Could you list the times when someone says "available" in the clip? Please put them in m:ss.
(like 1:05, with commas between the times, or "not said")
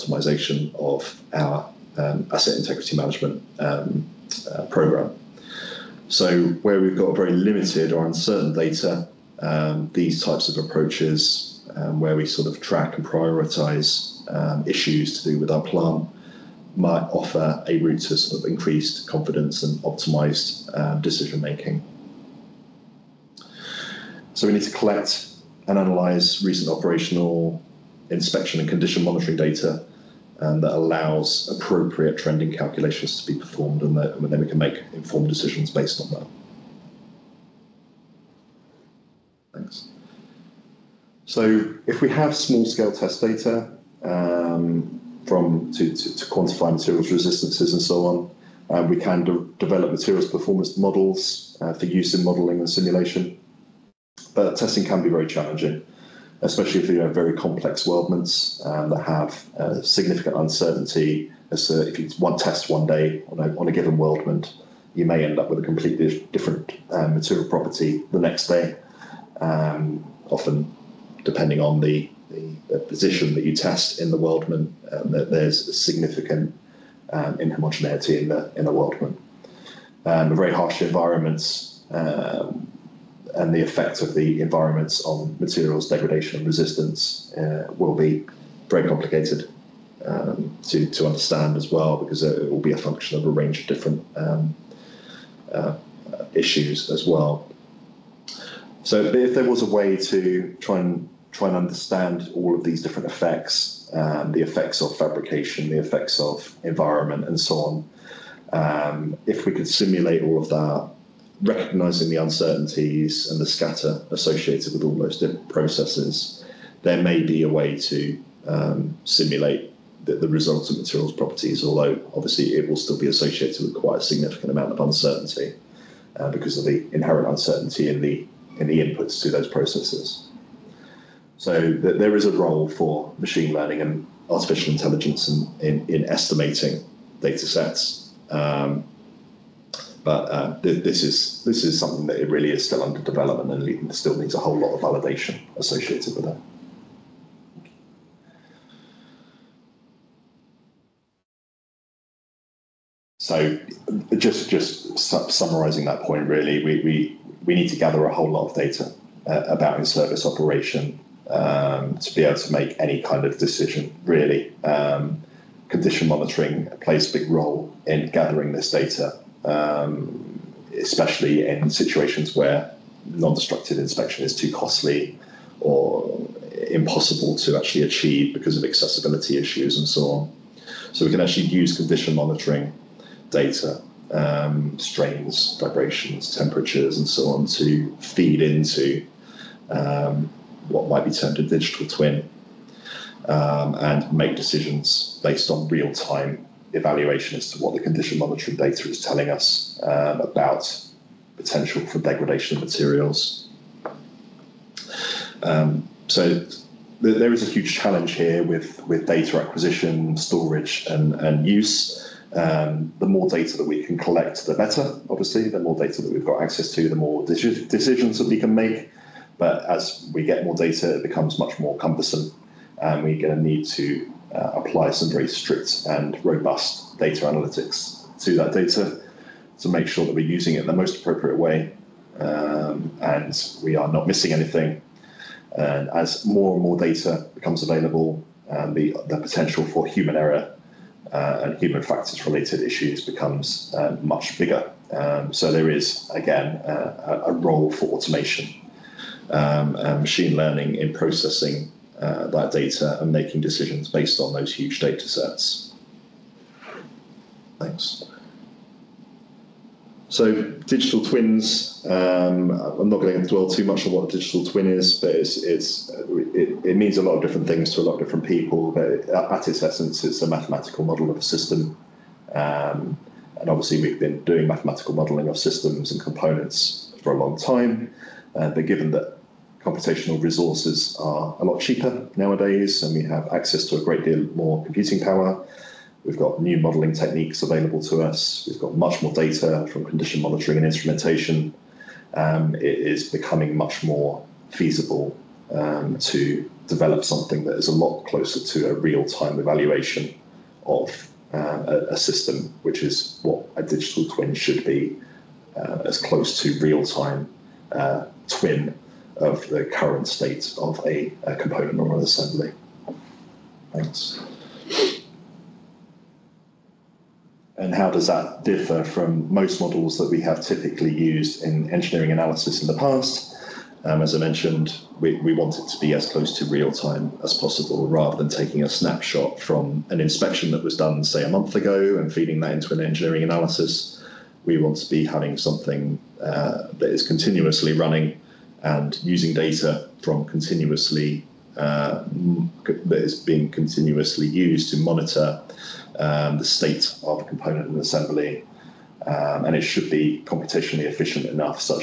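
3:57, 4:47.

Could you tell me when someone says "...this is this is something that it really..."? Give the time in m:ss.
2:20.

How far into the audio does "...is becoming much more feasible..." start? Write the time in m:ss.
4:52.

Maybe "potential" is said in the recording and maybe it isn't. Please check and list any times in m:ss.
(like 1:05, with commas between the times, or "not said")
3:21, 3:59.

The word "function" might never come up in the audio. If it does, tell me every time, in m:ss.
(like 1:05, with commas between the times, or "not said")
1:32.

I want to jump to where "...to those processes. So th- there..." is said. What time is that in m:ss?
2:09.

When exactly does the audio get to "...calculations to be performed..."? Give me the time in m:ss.
0:32.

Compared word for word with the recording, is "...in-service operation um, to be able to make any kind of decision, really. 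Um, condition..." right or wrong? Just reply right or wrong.
right.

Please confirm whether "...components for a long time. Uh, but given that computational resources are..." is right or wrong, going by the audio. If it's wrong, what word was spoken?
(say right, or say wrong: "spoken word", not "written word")
right.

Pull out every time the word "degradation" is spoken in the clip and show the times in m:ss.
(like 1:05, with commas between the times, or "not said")
1:25, 3:21.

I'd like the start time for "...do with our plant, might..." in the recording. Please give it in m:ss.
0:15.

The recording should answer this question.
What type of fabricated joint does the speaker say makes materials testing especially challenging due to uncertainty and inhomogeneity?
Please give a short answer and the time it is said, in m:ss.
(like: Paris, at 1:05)
weldments, at 0:57.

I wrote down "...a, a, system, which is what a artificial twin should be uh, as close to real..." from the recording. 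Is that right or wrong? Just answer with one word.
wrong.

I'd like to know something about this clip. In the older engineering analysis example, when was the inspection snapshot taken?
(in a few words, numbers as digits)
a month ago.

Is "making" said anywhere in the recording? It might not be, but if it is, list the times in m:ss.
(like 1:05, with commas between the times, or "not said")
0:21, 4:13.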